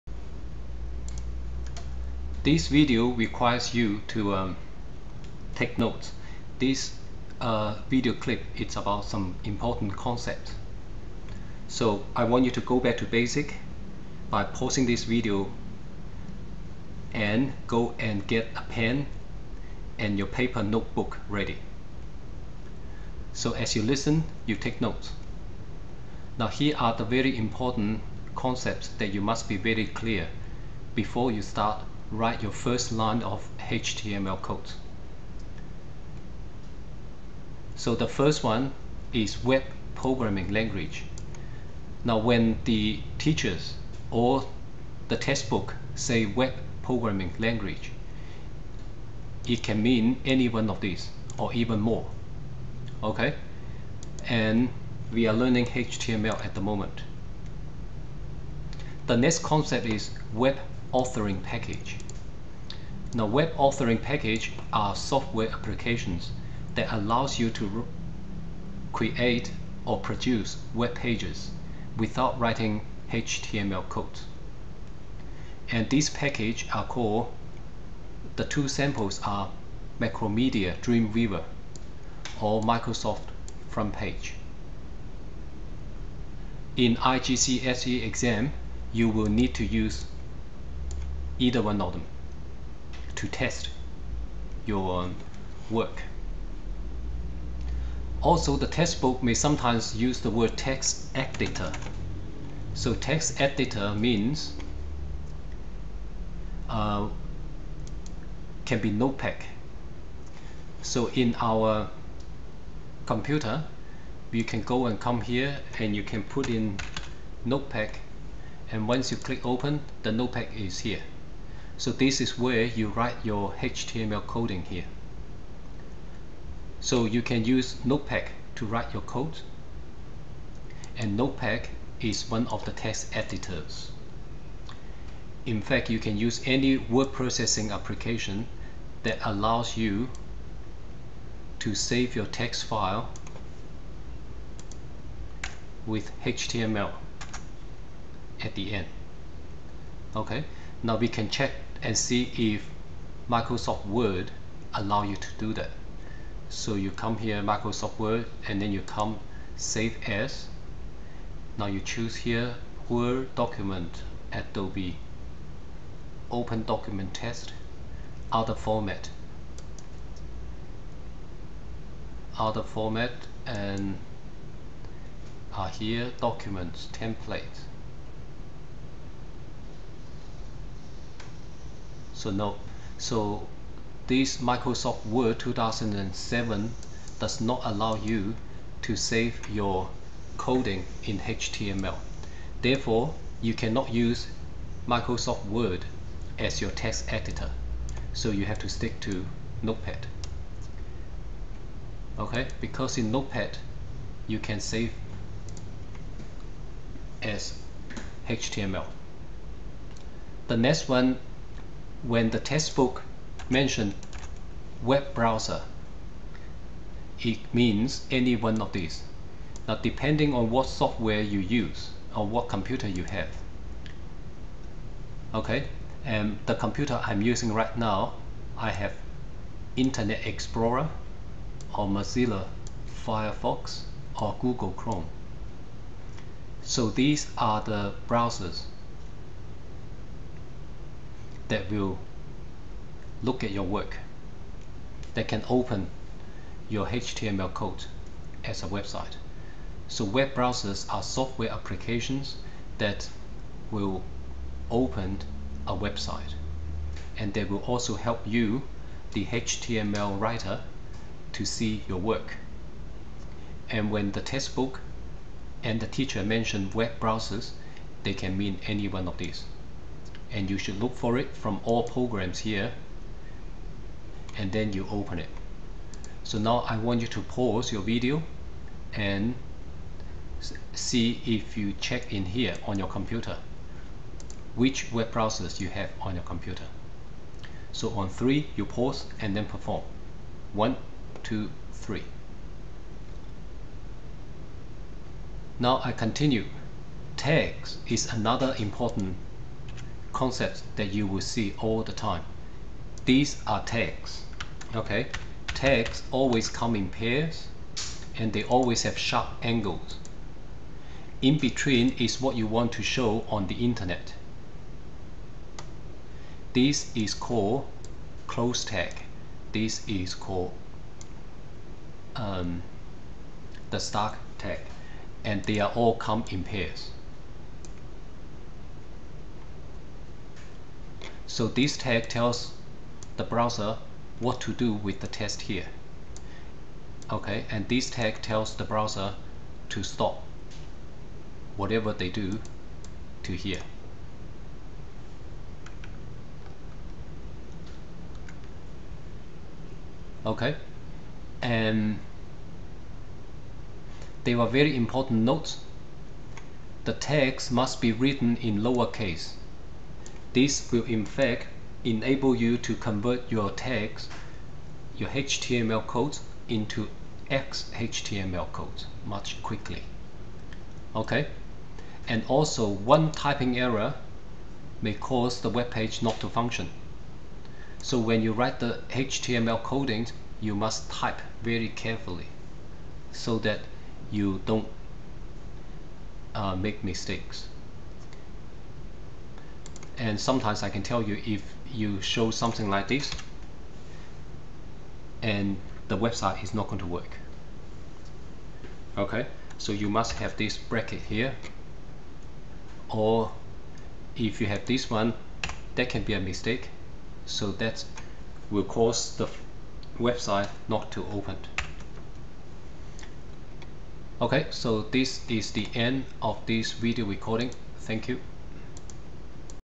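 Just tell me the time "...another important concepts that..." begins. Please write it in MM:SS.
04:58.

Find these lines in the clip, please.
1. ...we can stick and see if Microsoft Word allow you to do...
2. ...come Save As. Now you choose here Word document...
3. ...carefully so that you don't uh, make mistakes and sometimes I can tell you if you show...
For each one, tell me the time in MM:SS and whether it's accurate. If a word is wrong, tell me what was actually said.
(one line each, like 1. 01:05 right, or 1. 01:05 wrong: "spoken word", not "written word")
1. 02:30 wrong: "check", not "stick"
2. 02:38 right
3. 06:21 right.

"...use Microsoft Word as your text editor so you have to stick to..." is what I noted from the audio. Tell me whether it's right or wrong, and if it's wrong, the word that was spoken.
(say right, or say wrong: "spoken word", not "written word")
right.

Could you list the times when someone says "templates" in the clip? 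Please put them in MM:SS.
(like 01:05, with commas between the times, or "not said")
02:56.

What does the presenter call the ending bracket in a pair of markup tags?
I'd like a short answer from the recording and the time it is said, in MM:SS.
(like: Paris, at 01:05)
close tag, at 05:18.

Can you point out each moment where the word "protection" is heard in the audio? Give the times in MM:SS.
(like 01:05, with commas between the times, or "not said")
not said.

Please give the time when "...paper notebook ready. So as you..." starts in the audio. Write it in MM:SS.
00:20.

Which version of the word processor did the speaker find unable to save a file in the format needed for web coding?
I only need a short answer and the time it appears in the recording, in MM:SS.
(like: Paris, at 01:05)
Microsoft Word 2007, at 03:04.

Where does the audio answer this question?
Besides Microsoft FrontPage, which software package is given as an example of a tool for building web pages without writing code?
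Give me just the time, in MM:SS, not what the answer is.
01:19.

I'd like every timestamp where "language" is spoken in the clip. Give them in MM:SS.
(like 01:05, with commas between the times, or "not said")
00:40, 00:47.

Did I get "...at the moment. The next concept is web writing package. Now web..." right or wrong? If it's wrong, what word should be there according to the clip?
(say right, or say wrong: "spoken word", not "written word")
wrong: "authoring", not "writing".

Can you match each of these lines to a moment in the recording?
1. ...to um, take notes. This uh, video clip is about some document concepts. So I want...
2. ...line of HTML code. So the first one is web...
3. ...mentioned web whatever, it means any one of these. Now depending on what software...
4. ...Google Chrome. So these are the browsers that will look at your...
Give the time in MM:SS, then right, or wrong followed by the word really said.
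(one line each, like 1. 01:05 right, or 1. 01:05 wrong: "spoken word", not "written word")
1. 00:04 wrong: "important", not "document"
2. 00:32 right
3. 03:33 wrong: "browser", not "whatever"
4. 03:54 right.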